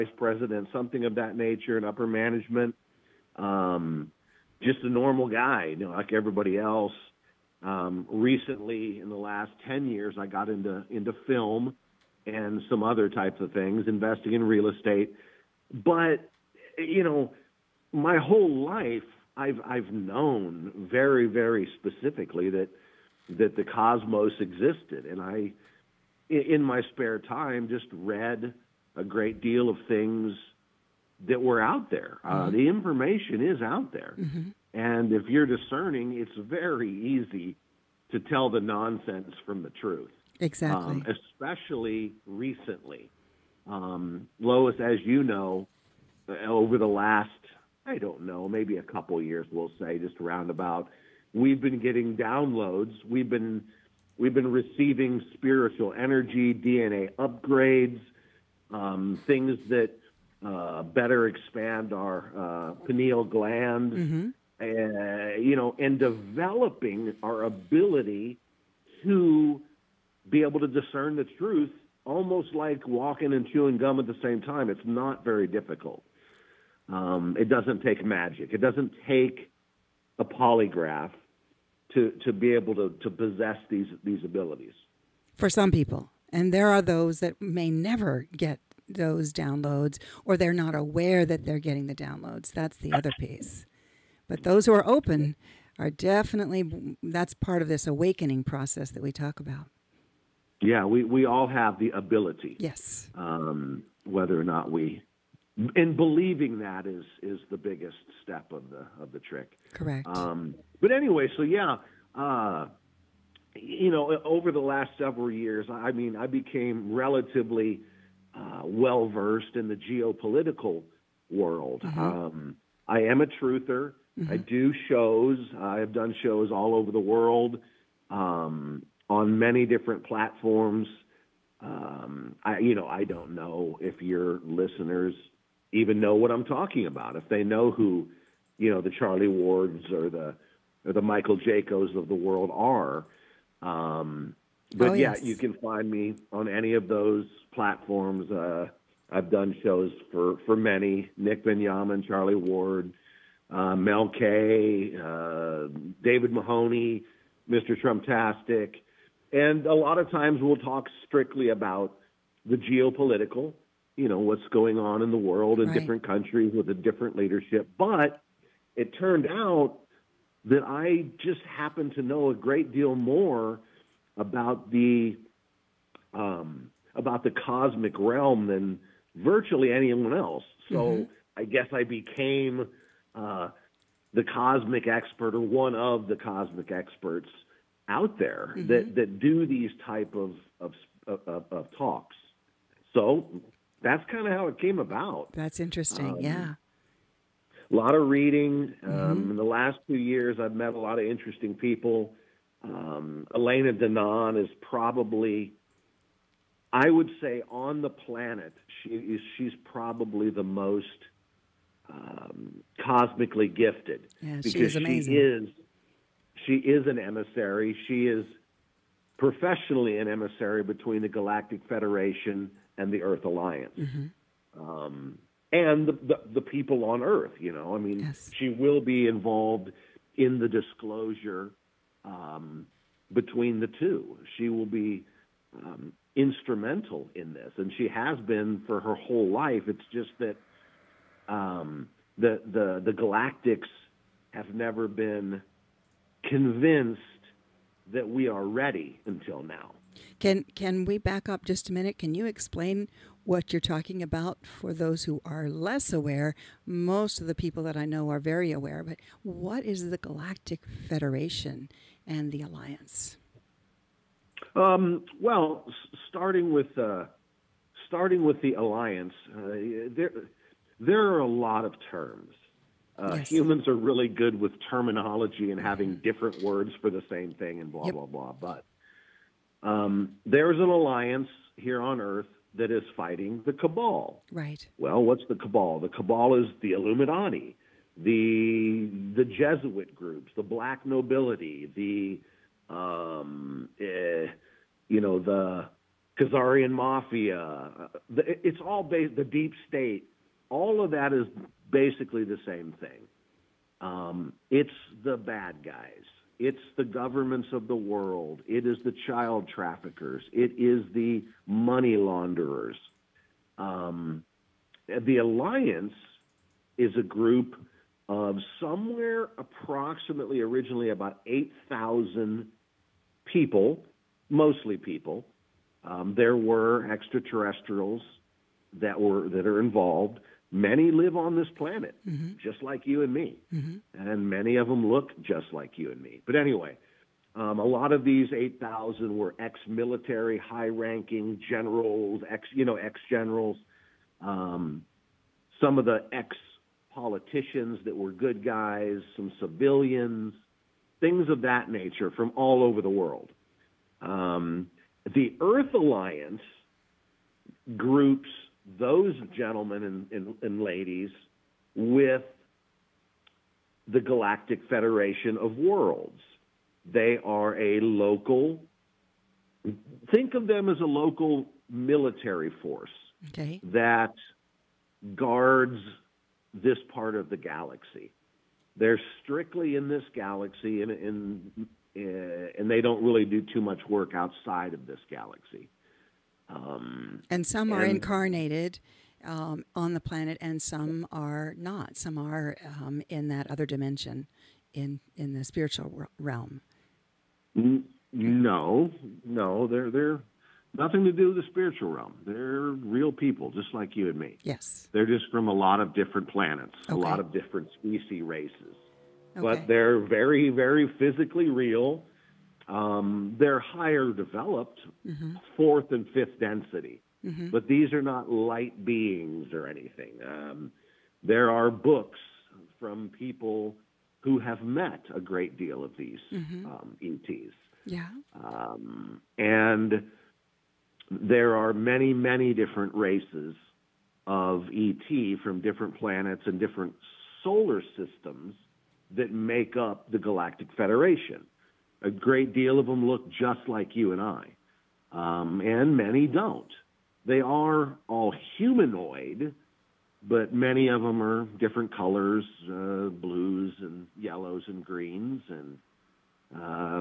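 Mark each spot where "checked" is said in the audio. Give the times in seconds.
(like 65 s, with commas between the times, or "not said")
not said.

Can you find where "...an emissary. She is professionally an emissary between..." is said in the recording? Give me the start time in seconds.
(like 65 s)
216 s.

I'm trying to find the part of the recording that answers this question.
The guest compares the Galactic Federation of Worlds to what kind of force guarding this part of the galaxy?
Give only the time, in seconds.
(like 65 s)
370 s.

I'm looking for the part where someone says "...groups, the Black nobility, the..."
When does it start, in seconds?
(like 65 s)
289 s.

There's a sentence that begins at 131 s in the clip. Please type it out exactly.
Um, I, you know, I don't know if your listeners even know what I'm talking about.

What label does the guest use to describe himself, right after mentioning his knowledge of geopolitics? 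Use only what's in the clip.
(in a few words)
A truther.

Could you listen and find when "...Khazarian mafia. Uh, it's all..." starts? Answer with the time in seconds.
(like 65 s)
296 s.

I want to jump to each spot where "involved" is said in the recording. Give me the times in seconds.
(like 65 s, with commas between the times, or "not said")
229 s, 329 s.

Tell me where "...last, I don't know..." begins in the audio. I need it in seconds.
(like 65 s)
46 s.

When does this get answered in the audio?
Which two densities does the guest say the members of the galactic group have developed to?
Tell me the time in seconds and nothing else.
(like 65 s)
415 s.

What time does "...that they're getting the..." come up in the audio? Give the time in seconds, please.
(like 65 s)
91 s.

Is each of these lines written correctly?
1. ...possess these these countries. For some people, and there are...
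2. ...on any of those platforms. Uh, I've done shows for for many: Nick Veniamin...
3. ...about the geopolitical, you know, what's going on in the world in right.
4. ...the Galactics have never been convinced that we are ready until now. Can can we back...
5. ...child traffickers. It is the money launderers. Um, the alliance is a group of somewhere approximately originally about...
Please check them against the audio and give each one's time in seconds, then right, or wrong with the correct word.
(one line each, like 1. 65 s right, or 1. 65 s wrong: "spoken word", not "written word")
1. 83 s wrong: "abilities", not "countries"
2. 146 s right
3. 161 s right
4. 242 s right
5. 309 s right.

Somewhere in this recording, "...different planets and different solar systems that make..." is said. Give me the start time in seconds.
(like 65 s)
435 s.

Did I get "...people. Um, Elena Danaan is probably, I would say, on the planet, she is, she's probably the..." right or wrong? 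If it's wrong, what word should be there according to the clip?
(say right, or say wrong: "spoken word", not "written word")
right.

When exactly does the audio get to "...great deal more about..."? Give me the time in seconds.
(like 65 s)
172 s.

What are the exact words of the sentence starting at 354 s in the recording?
Um, the Earth Alliance groups those gentlemen and, and, and ladies with the Galactic Federation of Worlds.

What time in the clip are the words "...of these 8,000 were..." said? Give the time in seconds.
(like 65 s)
337 s.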